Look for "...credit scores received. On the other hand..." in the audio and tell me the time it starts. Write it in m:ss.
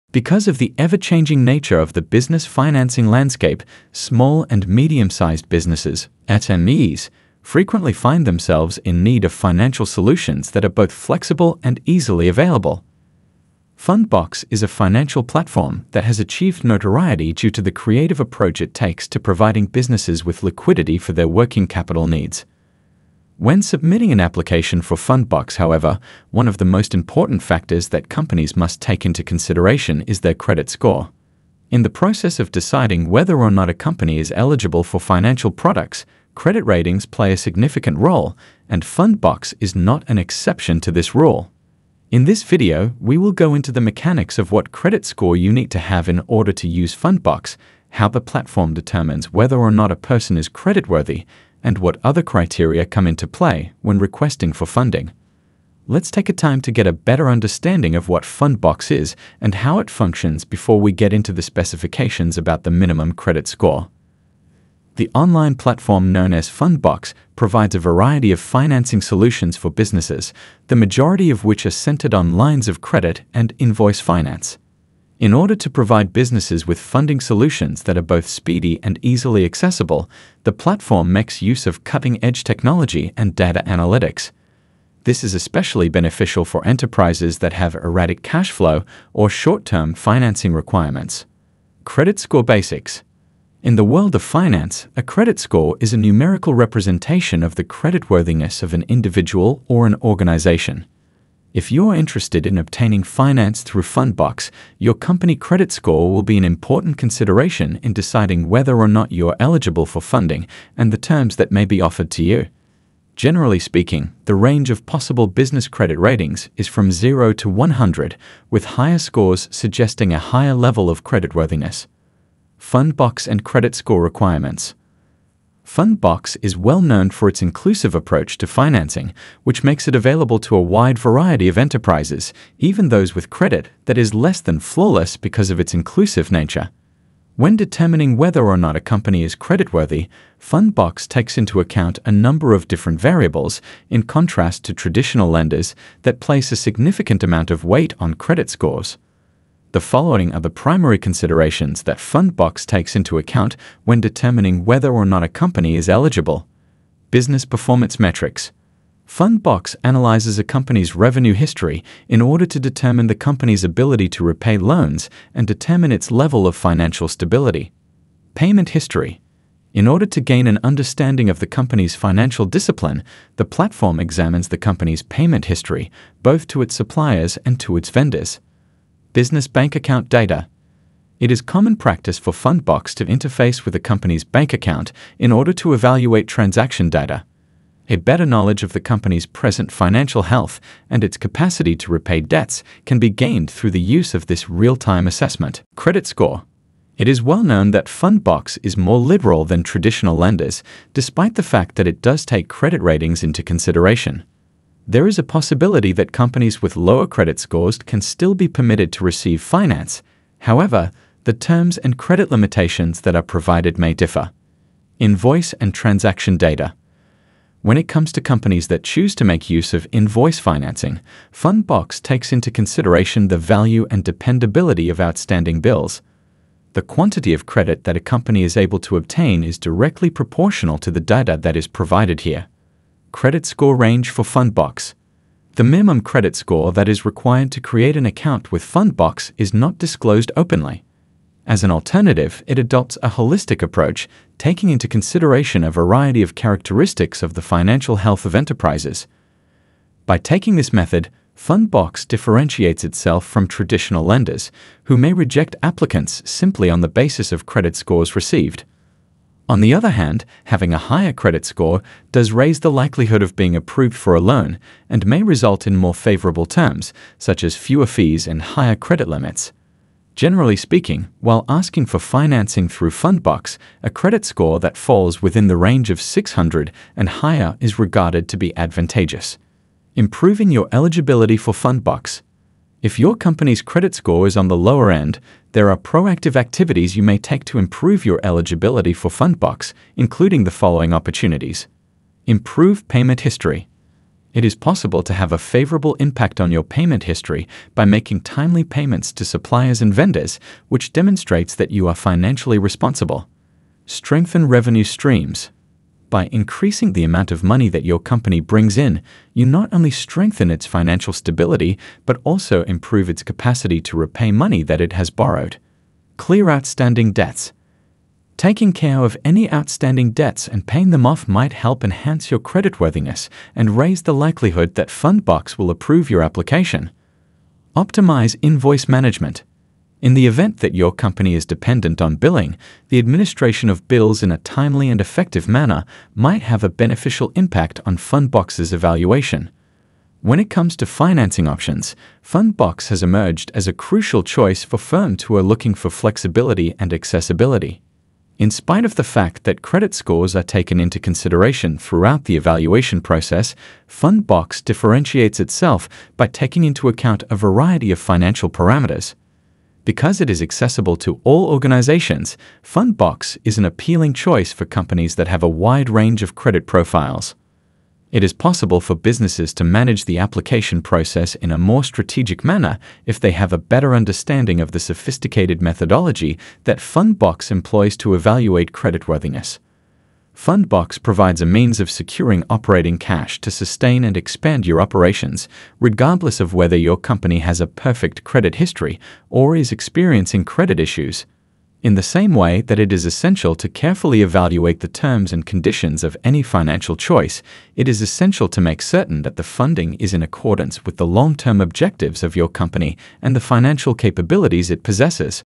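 4:17.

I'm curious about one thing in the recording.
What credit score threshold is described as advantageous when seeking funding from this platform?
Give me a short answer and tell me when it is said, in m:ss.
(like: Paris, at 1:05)
600, at 4:35.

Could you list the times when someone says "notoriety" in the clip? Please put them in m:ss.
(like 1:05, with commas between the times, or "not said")
0:16.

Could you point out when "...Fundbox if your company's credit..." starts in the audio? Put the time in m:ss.
4:41.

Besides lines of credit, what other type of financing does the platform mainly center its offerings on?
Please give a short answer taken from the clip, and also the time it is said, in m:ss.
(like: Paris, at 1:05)
invoice finance, at 1:13.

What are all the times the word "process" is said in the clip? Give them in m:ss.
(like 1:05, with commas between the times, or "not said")
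0:31, 5:53, 6:10.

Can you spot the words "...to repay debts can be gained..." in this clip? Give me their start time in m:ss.
3:11.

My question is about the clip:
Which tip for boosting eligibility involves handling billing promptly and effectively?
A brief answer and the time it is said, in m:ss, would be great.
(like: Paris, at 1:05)
Optimize invoice management, at 5:27.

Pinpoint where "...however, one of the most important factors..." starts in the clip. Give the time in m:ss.
0:25.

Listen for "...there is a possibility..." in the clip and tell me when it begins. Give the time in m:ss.
3:24.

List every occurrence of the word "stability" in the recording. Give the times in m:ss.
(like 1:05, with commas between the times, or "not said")
2:47, 5:11.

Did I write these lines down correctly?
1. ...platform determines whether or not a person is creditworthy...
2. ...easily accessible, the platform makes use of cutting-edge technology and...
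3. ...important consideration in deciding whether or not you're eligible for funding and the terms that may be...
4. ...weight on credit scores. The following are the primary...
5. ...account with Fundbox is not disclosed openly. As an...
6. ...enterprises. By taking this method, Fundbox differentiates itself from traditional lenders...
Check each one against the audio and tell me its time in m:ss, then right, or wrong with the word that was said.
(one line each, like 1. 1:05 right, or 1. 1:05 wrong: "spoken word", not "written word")
1. 0:48 right
2. 1:19 right
3. 1:46 right
4. 2:27 right
5. 3:58 right
6. 4:08 right.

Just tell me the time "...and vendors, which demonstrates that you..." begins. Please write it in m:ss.
4:59.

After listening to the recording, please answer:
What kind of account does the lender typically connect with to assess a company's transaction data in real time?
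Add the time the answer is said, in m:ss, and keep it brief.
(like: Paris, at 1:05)
business bank account, at 2:59.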